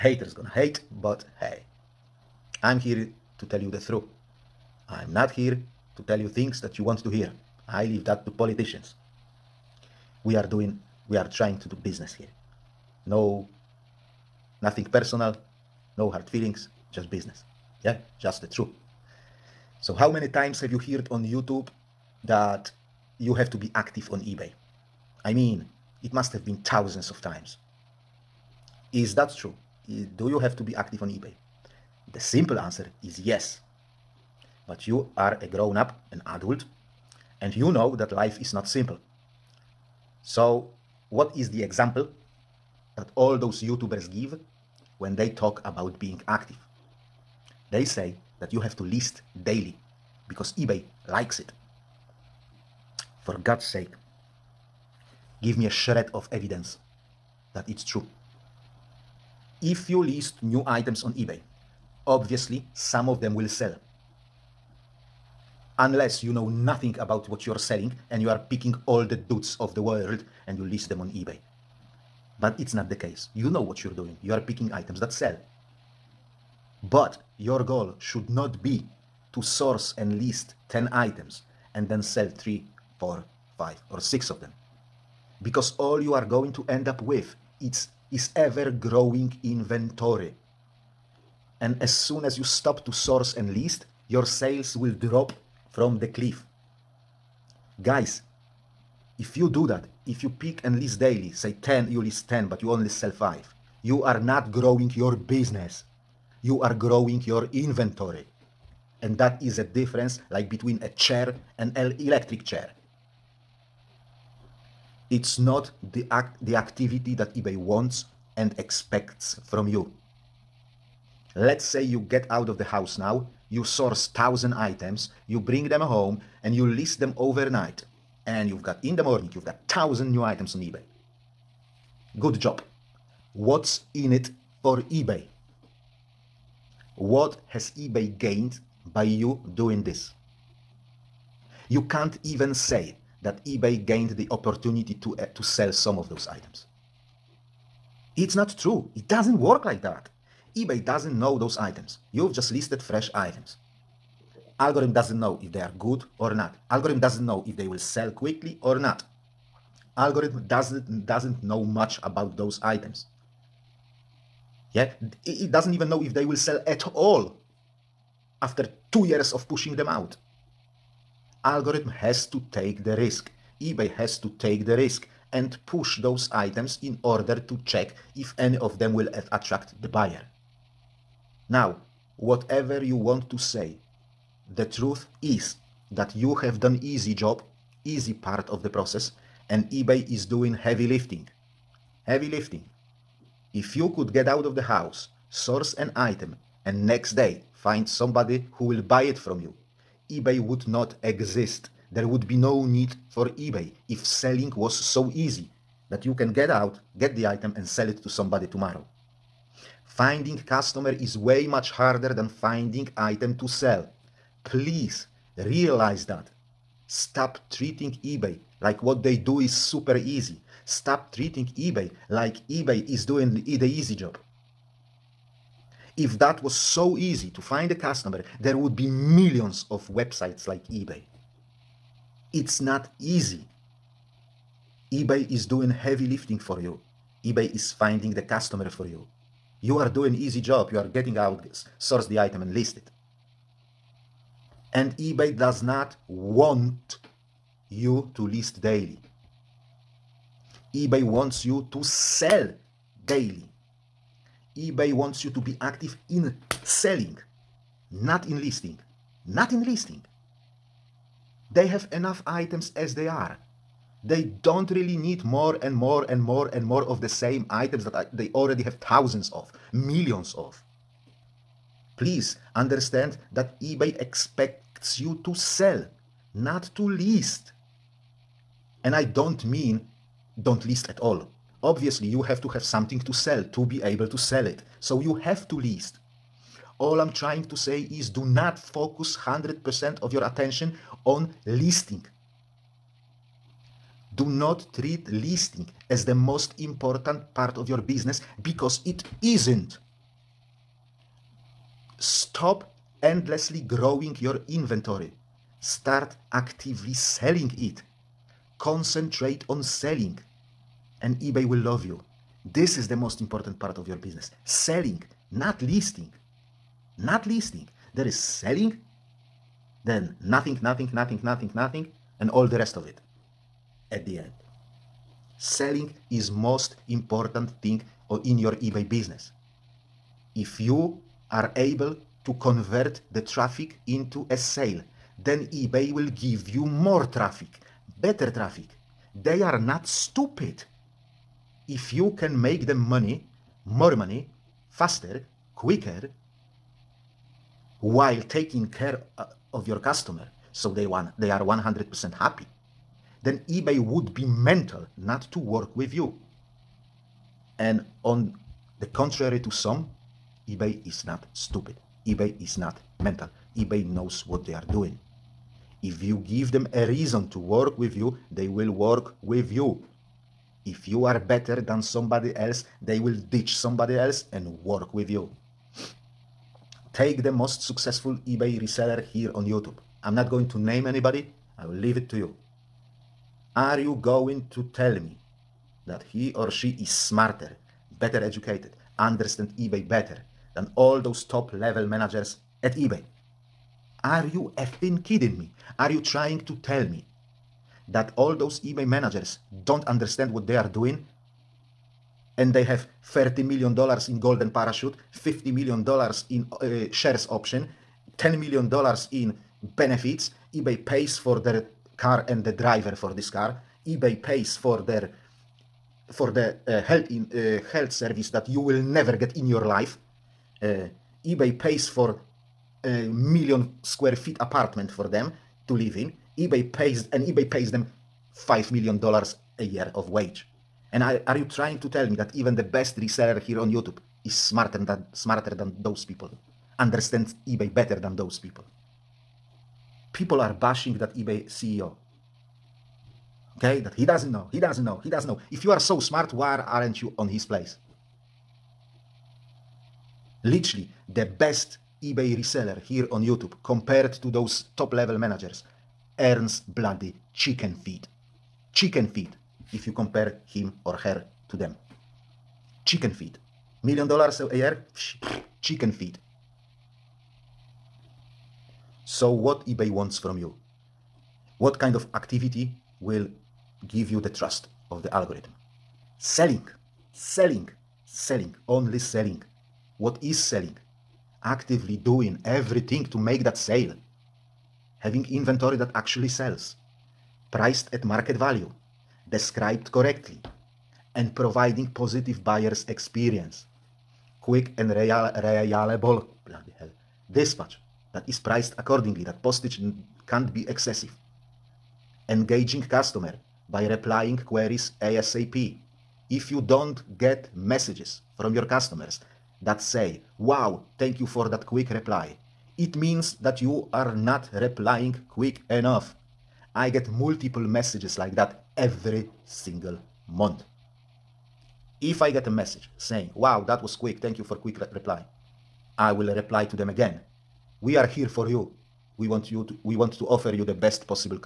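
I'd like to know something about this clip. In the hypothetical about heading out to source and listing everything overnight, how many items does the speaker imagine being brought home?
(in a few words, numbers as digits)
1000.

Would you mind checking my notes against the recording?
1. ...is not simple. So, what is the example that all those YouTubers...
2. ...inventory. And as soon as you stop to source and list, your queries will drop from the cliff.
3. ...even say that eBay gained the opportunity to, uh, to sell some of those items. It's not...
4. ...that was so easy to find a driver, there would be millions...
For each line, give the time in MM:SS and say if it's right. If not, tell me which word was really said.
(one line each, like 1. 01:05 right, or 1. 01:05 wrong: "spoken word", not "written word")
1. 00:38 right
2. 01:29 wrong: "sales", not "queries"
3. 02:22 right
4. 03:46 wrong: "customer", not "driver".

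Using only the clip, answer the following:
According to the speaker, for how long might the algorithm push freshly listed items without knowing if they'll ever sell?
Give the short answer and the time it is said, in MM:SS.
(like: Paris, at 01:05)
2 years, at 02:48.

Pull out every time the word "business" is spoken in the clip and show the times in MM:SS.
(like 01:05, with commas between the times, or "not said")
00:11, 00:17, 01:45, 04:57, 05:14, 05:28.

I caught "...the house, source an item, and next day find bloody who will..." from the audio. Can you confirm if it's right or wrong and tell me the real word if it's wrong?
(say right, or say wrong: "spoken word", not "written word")
wrong: "somebody", not "bloody".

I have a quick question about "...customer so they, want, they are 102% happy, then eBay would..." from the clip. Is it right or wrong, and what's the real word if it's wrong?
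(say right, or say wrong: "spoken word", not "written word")
wrong: "100", not "102".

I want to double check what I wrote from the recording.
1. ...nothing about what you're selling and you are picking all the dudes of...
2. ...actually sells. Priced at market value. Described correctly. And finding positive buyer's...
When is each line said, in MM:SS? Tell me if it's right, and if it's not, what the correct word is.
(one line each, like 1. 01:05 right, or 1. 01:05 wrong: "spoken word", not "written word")
1. 01:06 right
2. 08:05 wrong: "providing", not "finding".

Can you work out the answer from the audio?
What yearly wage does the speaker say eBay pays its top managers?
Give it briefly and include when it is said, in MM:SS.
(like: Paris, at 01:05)
$5 million, at 07:08.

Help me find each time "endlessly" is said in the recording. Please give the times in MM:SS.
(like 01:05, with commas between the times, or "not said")
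05:03.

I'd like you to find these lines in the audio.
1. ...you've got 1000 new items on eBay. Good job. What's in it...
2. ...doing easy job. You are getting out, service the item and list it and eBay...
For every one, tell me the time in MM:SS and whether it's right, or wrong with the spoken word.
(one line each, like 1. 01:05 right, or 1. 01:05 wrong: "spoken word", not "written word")
1. 02:09 right
2. 03:59 wrong: "source", not "service".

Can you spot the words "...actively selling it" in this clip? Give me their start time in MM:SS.
05:06.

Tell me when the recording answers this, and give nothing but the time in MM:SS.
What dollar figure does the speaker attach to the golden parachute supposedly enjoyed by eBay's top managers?
06:43.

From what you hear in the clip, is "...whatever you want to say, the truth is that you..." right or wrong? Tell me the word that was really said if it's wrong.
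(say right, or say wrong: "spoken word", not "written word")
right.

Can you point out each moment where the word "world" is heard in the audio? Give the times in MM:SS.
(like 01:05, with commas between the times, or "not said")
01:09.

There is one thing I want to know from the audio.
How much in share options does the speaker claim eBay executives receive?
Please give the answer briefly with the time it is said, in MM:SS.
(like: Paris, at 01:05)
$50 million, at 06:45.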